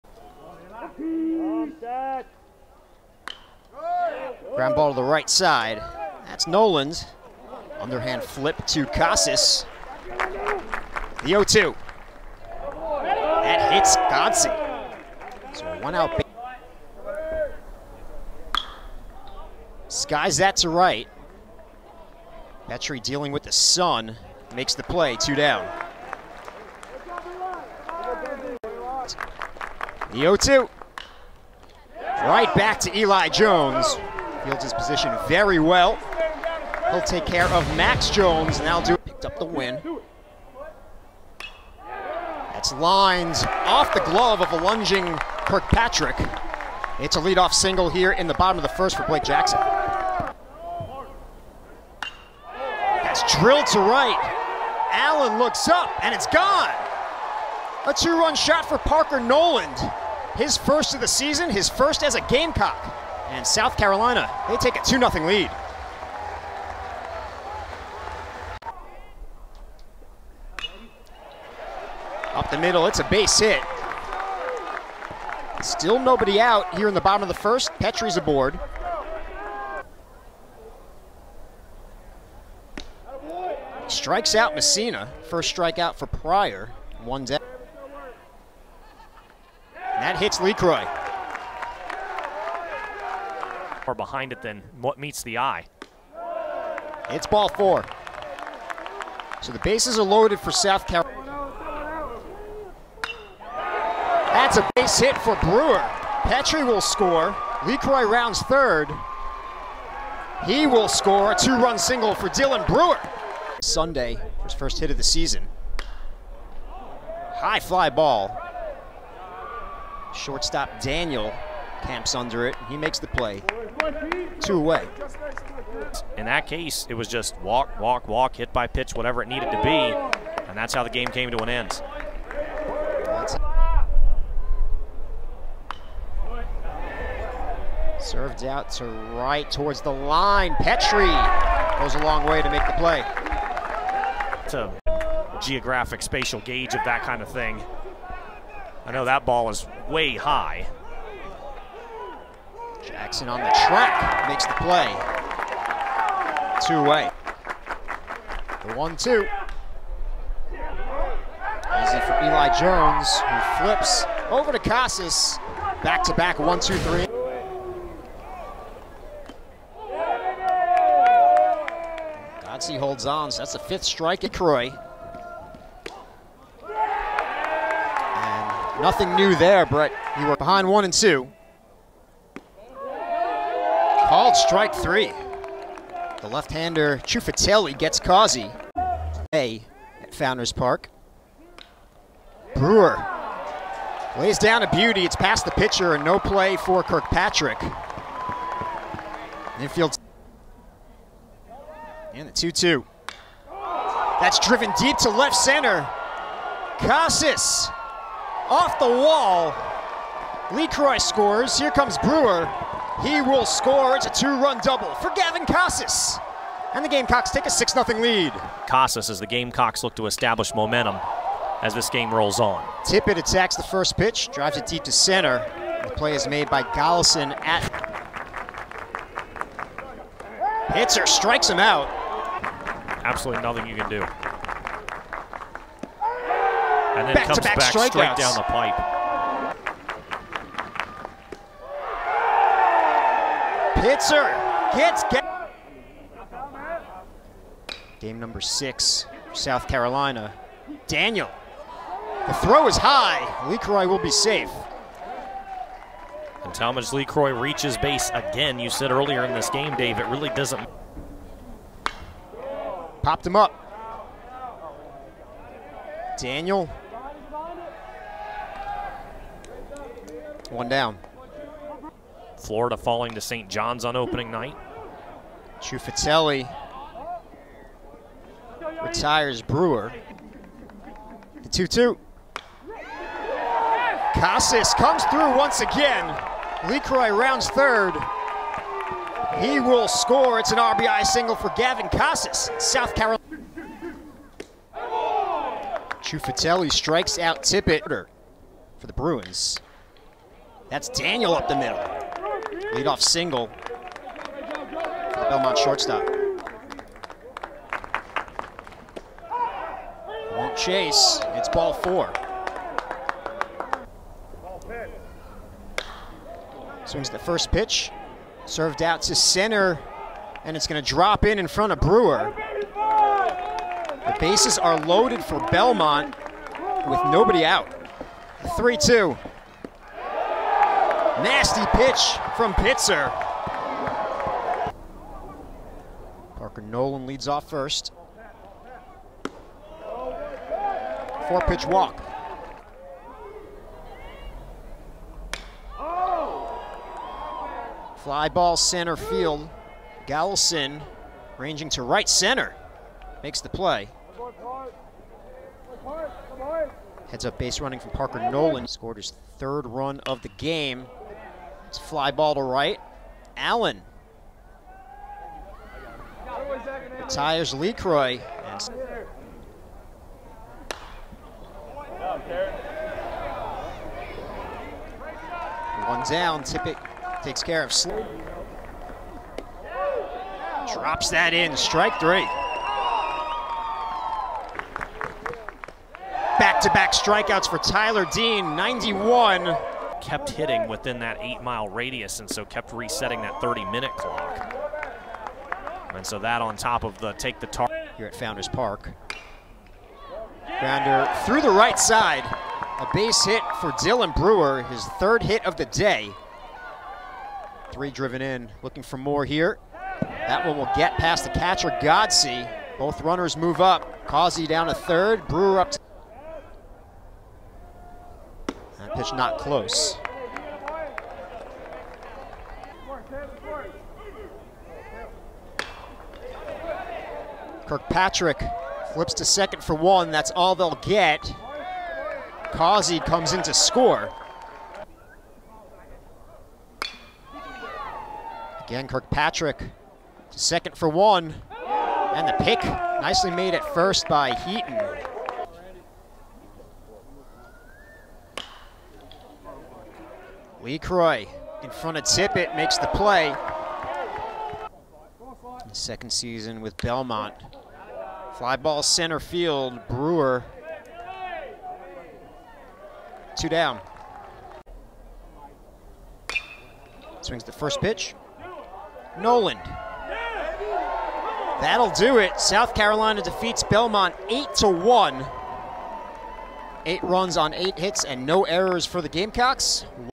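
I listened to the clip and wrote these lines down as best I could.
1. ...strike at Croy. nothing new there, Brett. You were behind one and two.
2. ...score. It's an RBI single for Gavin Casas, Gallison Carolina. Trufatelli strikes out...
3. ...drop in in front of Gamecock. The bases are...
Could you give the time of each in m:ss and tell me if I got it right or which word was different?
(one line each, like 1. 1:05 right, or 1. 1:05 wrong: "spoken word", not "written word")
1. 2:53 right
2. 4:49 wrong: "South", not "Gallison"
3. 5:20 wrong: "Brewer", not "Gamecock".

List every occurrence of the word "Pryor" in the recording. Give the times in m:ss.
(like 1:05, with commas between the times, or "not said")
1:26.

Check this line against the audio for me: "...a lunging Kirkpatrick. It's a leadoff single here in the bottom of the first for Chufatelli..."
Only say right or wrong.
wrong.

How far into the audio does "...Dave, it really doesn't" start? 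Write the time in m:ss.
4:19.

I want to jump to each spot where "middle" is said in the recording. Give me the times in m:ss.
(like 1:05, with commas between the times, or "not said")
1:12, 5:01.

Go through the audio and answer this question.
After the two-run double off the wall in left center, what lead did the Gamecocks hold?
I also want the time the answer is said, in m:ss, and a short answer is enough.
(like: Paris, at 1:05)
6-0, at 3:37.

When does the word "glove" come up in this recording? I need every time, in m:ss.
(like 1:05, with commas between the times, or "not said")
0:44.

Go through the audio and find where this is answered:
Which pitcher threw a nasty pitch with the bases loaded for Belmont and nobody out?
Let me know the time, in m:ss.
5:31.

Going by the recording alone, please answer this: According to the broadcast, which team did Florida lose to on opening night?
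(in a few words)
St. John's.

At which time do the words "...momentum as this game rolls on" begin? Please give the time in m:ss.
3:40.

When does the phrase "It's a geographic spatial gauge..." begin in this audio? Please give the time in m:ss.
2:24.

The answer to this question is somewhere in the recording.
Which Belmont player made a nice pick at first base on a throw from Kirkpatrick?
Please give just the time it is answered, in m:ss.
7:24.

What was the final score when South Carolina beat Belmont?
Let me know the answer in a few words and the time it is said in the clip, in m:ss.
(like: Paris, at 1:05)
8 to 1, at 7:54.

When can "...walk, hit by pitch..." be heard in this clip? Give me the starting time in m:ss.
2:08.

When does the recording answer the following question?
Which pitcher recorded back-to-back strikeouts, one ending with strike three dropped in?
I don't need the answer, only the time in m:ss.
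6:27.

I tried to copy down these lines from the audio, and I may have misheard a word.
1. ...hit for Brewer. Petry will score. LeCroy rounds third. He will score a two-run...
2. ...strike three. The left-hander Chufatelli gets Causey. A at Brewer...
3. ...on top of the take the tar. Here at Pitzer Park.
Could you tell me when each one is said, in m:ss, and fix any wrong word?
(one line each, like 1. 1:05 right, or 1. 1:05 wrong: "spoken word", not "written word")
1. 1:44 right
2. 3:04 wrong: "Founders", not "Brewer"
3. 6:36 wrong: "Founders", not "Pitzer".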